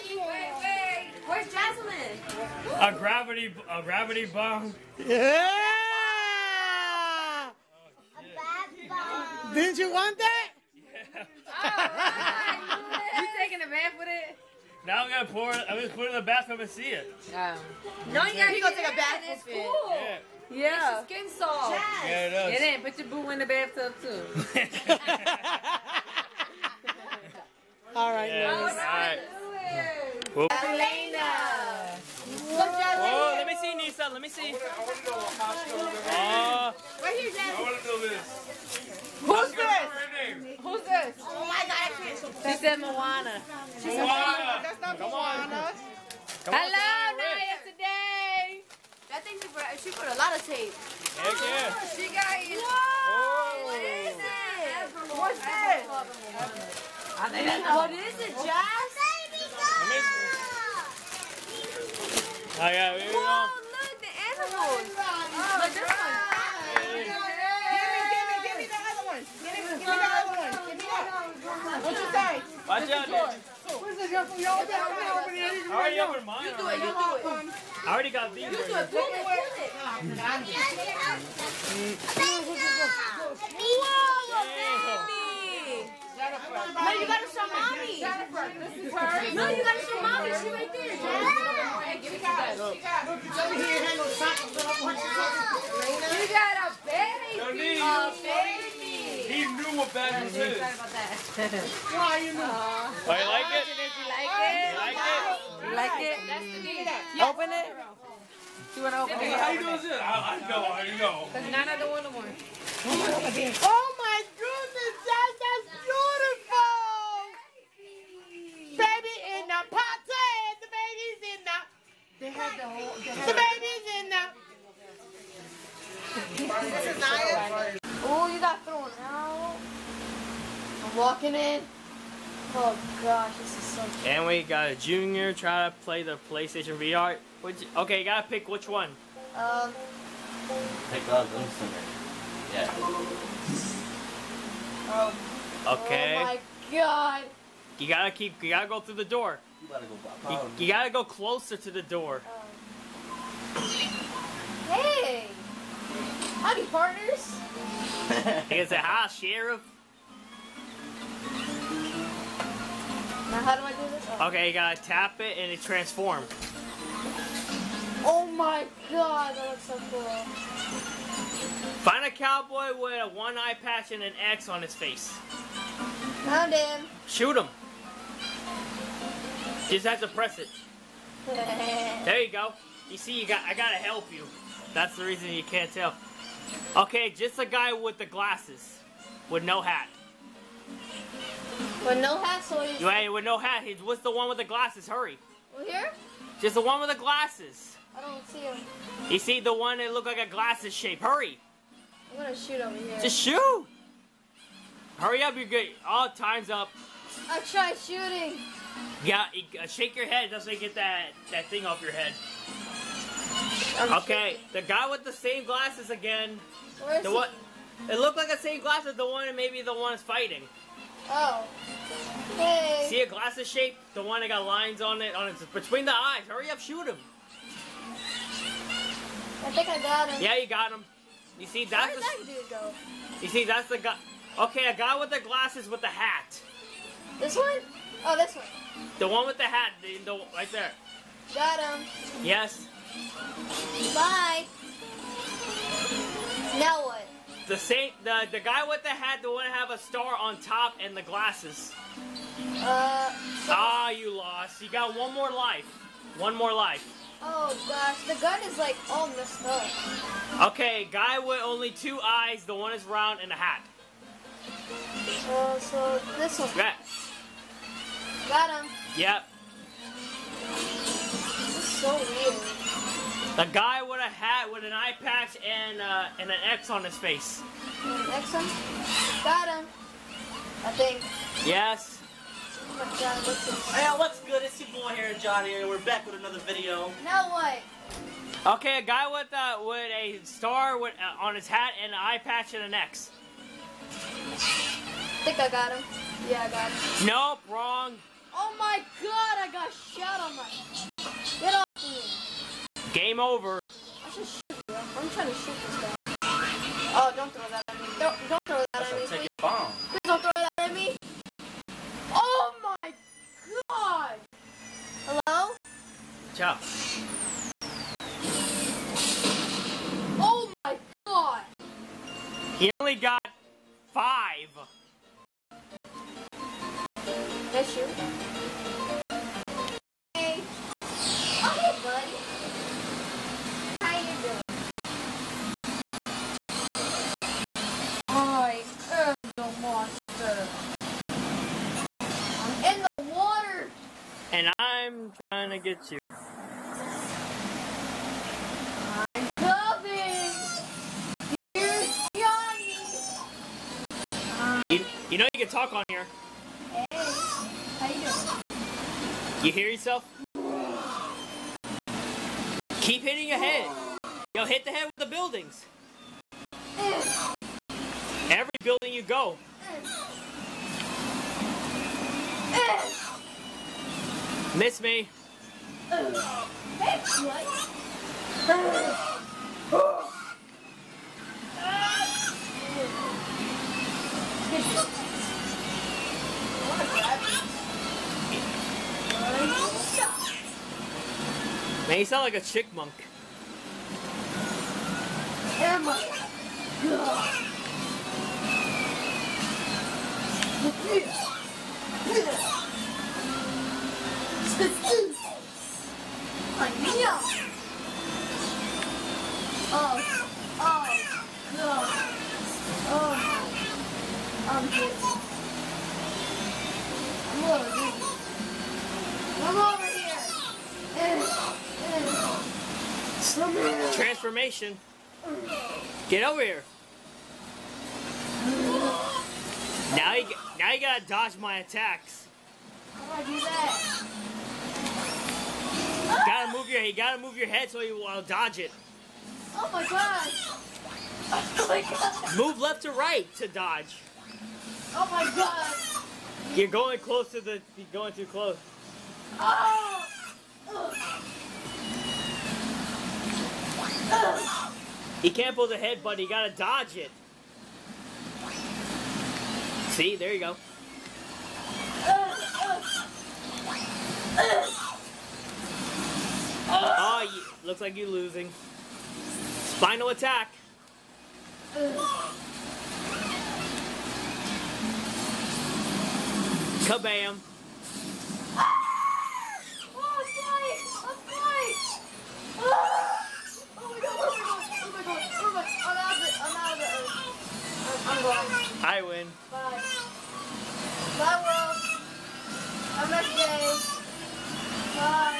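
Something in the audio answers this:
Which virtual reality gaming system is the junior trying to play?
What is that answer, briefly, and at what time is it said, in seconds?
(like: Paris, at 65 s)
PlayStation VR, at 136 s.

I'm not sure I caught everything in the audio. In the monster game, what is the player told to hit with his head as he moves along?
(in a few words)
The buildings.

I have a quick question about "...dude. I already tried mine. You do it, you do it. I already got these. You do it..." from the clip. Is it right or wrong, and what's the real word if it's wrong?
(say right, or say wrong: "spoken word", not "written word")
wrong: "opened", not "tried".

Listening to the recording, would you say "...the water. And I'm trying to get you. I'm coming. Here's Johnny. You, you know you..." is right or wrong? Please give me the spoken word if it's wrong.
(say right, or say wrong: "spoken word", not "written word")
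right.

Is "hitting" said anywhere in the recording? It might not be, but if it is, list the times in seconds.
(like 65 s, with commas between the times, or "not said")
363 s.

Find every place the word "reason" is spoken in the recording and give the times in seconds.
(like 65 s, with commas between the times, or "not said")
185 s.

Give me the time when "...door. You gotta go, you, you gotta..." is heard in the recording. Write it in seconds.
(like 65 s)
149 s.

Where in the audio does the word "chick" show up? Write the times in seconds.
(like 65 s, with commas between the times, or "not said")
392 s.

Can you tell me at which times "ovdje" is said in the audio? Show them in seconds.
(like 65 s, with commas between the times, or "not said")
not said.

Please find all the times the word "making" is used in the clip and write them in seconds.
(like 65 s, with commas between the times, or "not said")
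not said.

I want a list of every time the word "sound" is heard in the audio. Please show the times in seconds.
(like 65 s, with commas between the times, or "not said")
392 s.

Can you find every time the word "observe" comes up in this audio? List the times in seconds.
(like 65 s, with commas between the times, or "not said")
not said.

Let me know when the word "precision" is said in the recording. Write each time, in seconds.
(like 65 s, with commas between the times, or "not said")
not said.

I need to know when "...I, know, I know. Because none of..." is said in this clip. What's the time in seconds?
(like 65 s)
109 s.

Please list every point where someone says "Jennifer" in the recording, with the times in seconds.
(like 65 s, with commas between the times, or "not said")
88 s.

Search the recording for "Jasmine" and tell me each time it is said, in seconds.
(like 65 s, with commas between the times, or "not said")
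1 s.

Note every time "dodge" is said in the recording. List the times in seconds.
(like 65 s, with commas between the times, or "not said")
431 s, 438 s, 443 s, 456 s.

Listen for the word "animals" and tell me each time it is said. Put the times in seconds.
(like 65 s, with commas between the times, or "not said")
64 s.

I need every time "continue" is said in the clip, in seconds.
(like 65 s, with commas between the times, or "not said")
not said.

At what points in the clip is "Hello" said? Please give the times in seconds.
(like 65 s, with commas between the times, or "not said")
46 s, 315 s.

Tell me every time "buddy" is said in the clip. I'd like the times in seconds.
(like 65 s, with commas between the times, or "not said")
331 s.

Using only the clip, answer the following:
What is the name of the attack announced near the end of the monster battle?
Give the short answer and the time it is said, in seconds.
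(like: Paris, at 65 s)
Spinal attack, at 469 s.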